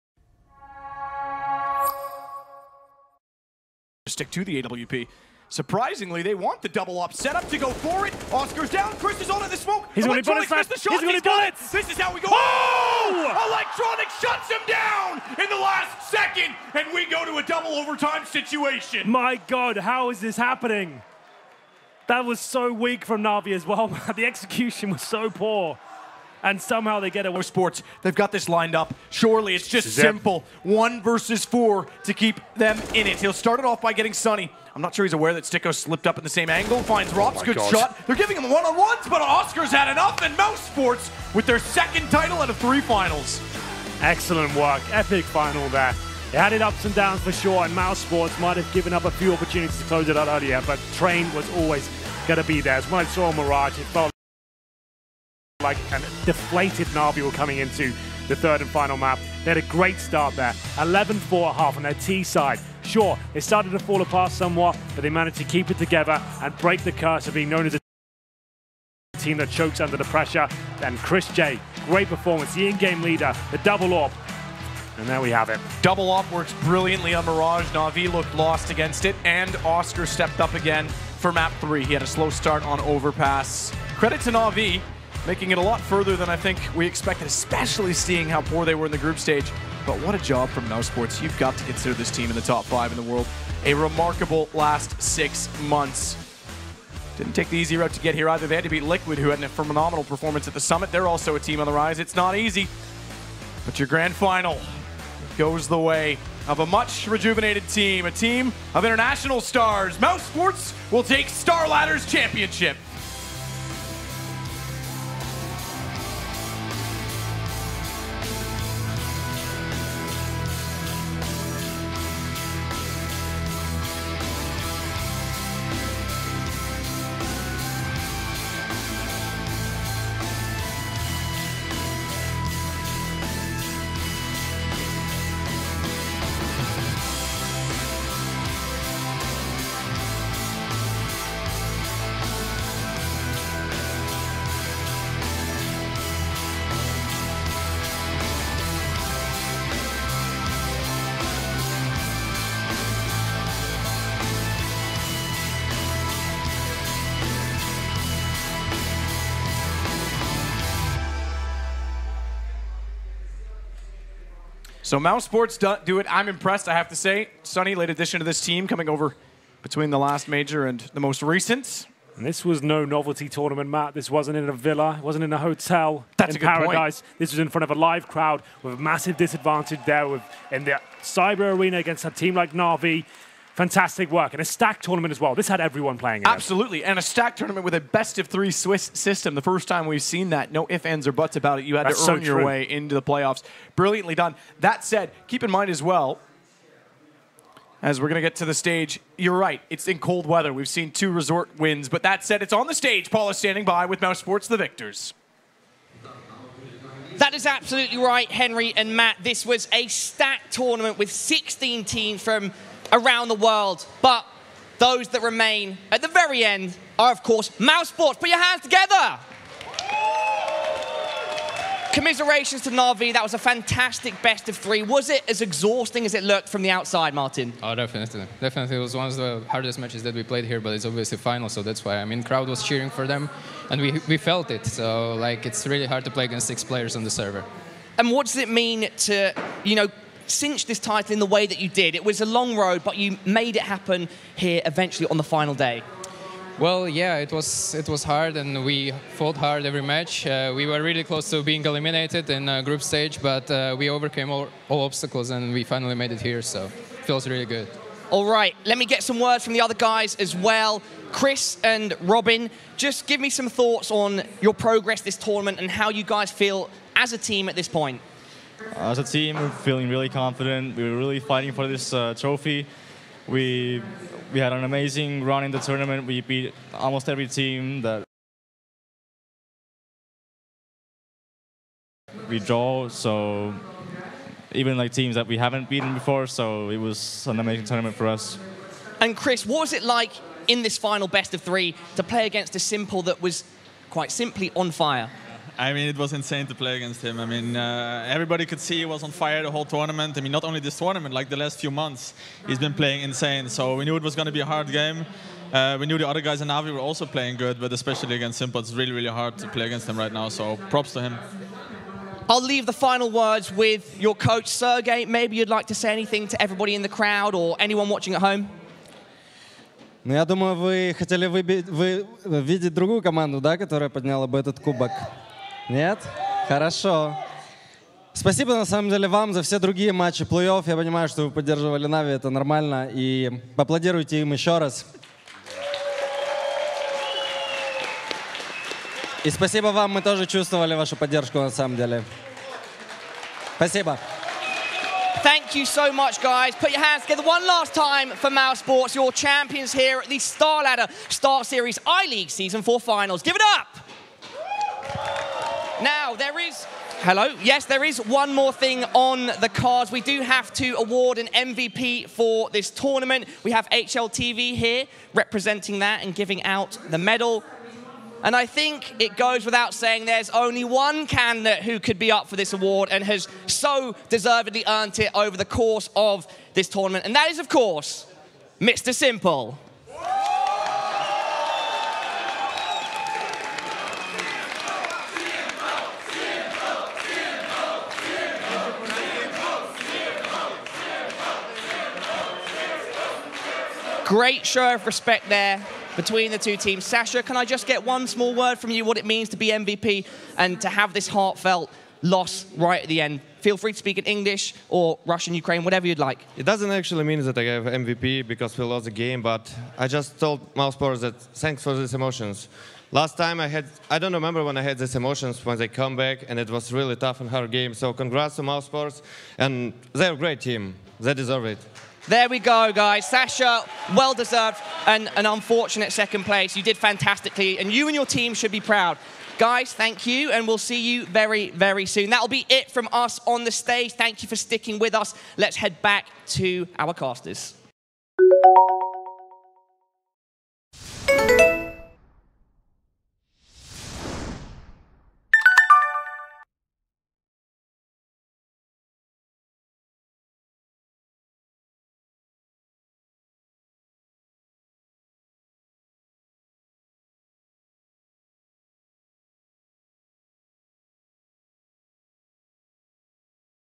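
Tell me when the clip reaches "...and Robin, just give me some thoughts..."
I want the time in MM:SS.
04:21.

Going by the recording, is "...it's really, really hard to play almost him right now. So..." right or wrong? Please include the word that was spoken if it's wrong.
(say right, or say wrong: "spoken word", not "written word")
wrong: "against", not "almost".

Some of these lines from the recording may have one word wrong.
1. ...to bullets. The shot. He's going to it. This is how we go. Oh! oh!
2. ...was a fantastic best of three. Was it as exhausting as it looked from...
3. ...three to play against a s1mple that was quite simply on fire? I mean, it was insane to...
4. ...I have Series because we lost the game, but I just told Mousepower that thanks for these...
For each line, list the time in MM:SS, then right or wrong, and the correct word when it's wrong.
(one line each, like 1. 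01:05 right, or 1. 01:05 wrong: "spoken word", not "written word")
1. 00:10 right
2. 03:43 right
3. 04:51 right
4. 06:47 wrong: "MVP", not "Series".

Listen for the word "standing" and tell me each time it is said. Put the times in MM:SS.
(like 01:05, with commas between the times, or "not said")
03:23.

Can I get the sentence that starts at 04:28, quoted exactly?
Uh, as a team, we're feeling really confident.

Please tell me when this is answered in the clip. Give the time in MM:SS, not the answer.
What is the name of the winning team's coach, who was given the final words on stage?
05:14.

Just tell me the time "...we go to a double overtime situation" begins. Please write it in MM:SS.
00:16.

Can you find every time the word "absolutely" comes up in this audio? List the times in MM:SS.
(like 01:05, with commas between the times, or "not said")
03:06, 03:27.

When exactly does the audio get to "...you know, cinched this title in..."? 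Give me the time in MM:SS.
03:59.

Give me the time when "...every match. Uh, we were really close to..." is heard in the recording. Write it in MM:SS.
04:09.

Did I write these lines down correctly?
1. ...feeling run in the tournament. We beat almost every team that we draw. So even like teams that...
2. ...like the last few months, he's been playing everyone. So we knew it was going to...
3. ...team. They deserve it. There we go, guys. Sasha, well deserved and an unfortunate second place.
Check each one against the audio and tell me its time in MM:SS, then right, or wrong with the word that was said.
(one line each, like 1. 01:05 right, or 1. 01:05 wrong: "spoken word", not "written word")
1. 04:34 wrong: "amazing", not "feeling"
2. 05:01 wrong: "insane", not "everyone"
3. 07:00 right.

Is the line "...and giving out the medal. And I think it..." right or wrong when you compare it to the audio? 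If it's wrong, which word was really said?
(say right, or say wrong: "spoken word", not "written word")
right.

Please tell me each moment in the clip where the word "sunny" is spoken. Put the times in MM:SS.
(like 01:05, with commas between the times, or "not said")
00:34, 02:47.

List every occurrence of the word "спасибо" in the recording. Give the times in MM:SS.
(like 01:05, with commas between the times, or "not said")
05:28, 05:39, 05:43.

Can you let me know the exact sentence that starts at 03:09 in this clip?
The first time we've seen that.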